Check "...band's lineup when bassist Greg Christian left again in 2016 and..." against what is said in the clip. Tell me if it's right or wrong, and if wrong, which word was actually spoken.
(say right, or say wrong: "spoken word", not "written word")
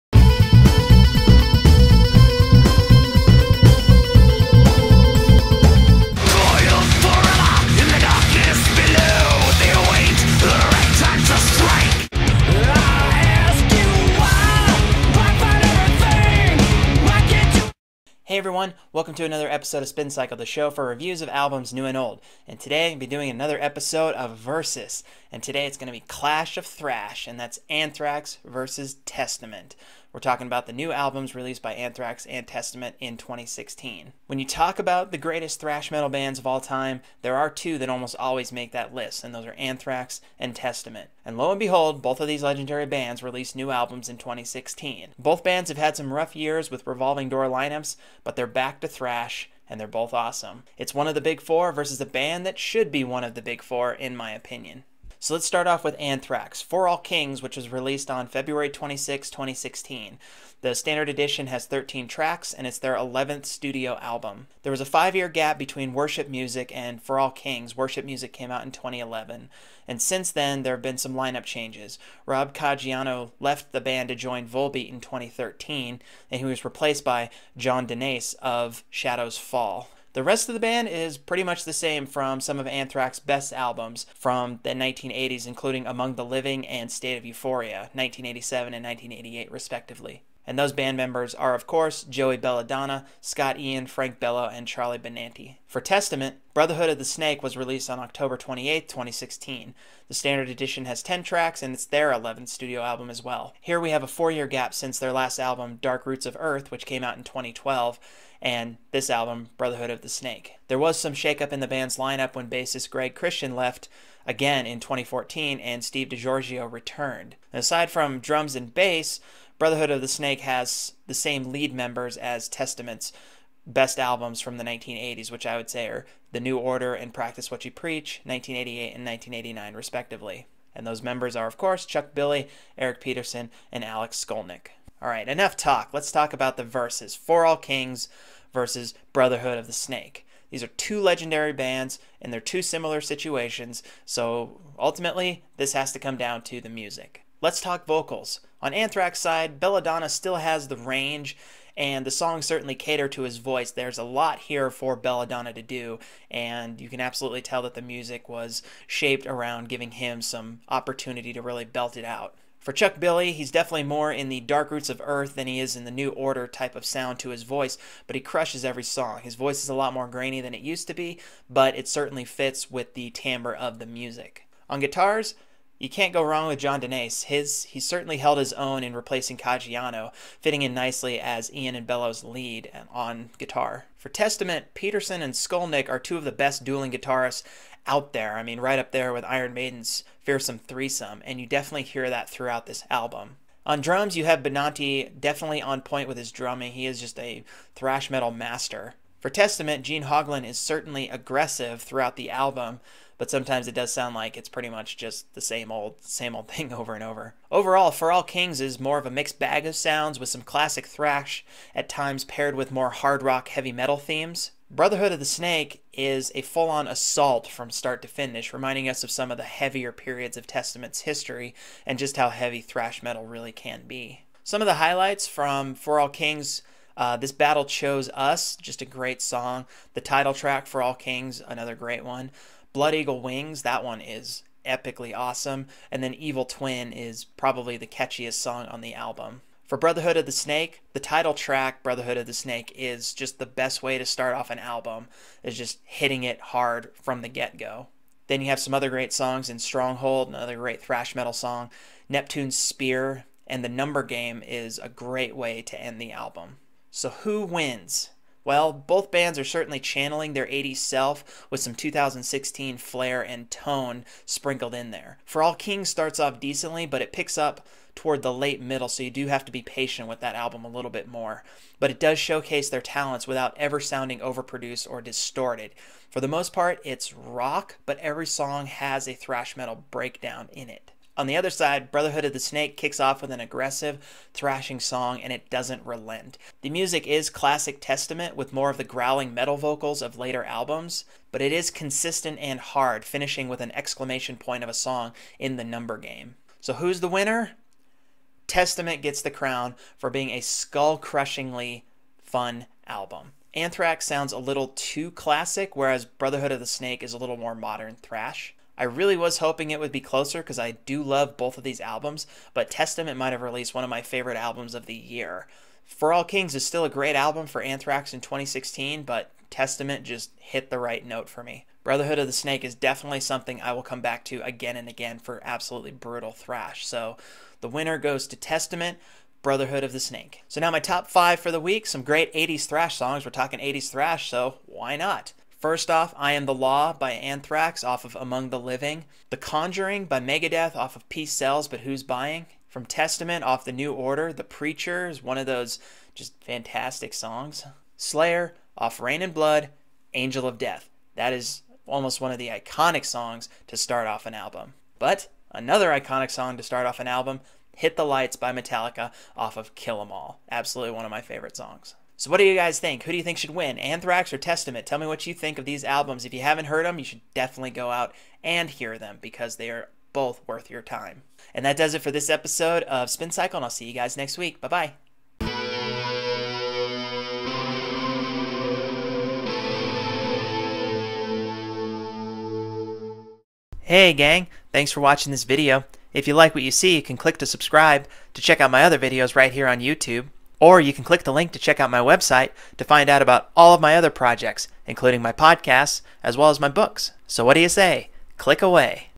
wrong: "2014", not "2016".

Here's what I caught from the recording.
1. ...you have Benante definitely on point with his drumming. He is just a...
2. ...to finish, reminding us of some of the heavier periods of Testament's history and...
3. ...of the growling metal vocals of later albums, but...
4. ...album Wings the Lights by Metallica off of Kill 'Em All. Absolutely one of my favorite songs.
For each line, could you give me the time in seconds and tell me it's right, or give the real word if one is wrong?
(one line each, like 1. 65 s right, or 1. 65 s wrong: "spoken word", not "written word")
1. 194 s right
2. 218 s right
3. 288 s right
4. 357 s wrong: "Hit", not "Wings".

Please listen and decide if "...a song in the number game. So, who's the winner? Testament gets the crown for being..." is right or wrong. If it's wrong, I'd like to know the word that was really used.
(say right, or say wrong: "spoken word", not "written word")
right.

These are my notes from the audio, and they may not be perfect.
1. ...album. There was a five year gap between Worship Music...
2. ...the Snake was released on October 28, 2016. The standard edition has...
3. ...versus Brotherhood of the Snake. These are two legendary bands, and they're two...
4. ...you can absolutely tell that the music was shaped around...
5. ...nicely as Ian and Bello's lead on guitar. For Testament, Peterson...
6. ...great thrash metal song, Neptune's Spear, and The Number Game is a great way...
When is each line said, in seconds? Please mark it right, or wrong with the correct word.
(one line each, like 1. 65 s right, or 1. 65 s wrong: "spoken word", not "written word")
1. 64 s right
2. 96 s right
3. 138 s right
4. 156 s right
5. 180 s right
6. 250 s right.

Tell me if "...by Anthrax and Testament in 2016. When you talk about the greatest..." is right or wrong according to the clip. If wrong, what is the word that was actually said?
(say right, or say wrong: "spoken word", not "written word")
right.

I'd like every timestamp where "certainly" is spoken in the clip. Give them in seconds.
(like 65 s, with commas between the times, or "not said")
152 s, 171 s, 177 s, 200 s, 259 s.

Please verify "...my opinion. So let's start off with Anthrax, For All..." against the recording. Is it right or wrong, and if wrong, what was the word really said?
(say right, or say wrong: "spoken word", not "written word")
right.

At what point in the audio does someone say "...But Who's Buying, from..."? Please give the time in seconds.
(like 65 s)
341 s.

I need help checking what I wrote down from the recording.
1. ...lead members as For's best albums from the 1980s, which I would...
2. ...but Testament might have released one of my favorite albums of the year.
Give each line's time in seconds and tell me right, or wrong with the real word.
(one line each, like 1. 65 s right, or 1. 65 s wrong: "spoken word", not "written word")
1. 121 s wrong: "Testament", not "For"
2. 312 s right.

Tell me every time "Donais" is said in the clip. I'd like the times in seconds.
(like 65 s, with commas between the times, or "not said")
77 s, 176 s.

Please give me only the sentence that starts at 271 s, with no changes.
But it does showcase their talents without ever sounding overproduced or distorted.